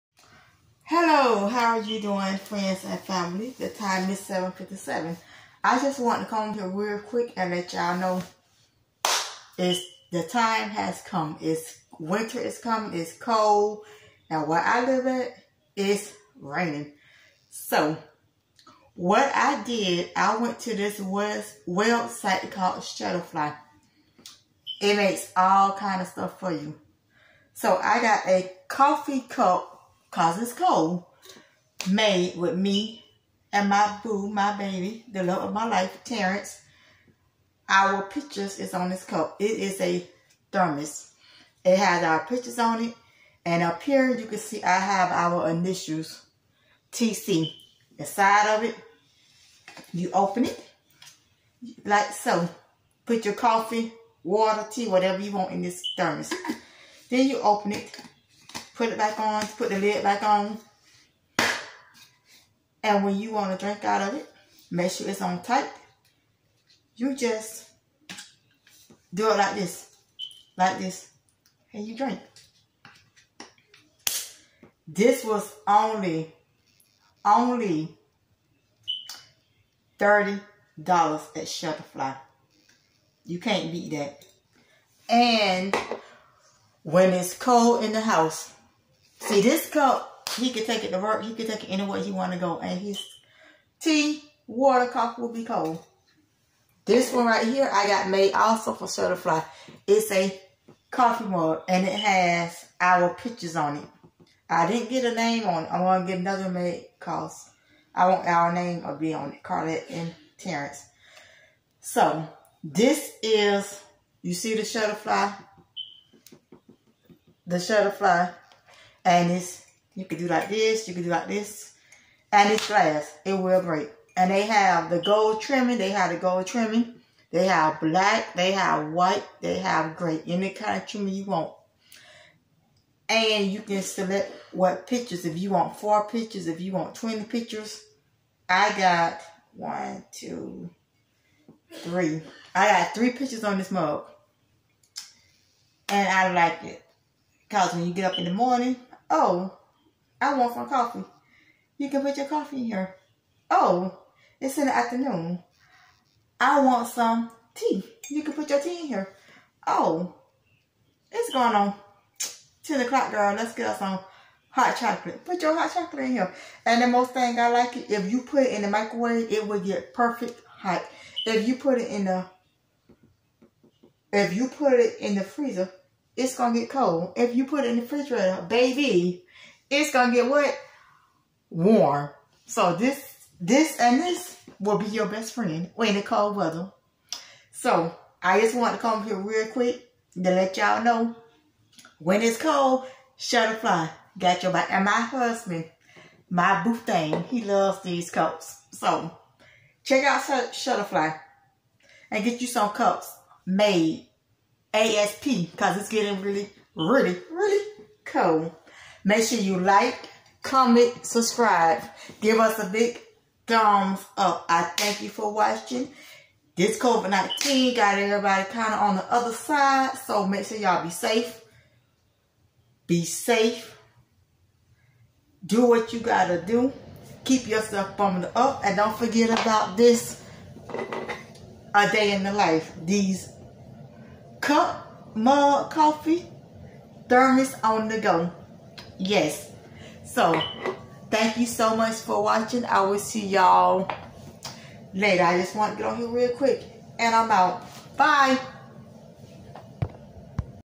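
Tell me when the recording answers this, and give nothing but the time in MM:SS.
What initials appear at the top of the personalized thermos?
00:46.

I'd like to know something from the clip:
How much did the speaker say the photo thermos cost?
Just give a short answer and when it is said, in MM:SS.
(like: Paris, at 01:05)
$30, at 01:19.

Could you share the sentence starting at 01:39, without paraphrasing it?
It's a coffee mug, and it has our pictures on it.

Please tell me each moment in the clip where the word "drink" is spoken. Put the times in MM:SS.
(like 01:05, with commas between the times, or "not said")
01:03, 01:11.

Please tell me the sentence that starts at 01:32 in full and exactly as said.
And his tea, water, coffee will be cold.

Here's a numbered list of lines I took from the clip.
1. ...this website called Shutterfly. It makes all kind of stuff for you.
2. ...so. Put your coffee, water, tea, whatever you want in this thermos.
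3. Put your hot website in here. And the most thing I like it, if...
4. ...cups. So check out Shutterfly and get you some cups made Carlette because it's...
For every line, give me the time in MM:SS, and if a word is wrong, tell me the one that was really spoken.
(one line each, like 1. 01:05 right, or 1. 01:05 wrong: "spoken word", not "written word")
1. 00:20 right
2. 00:52 right
3. 02:45 wrong: "chocolate", not "website"
4. 03:18 wrong: "ASP", not "Carlette".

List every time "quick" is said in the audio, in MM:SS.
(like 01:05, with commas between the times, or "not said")
00:06, 03:09, 04:06.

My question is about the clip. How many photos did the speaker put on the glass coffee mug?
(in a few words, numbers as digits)
3.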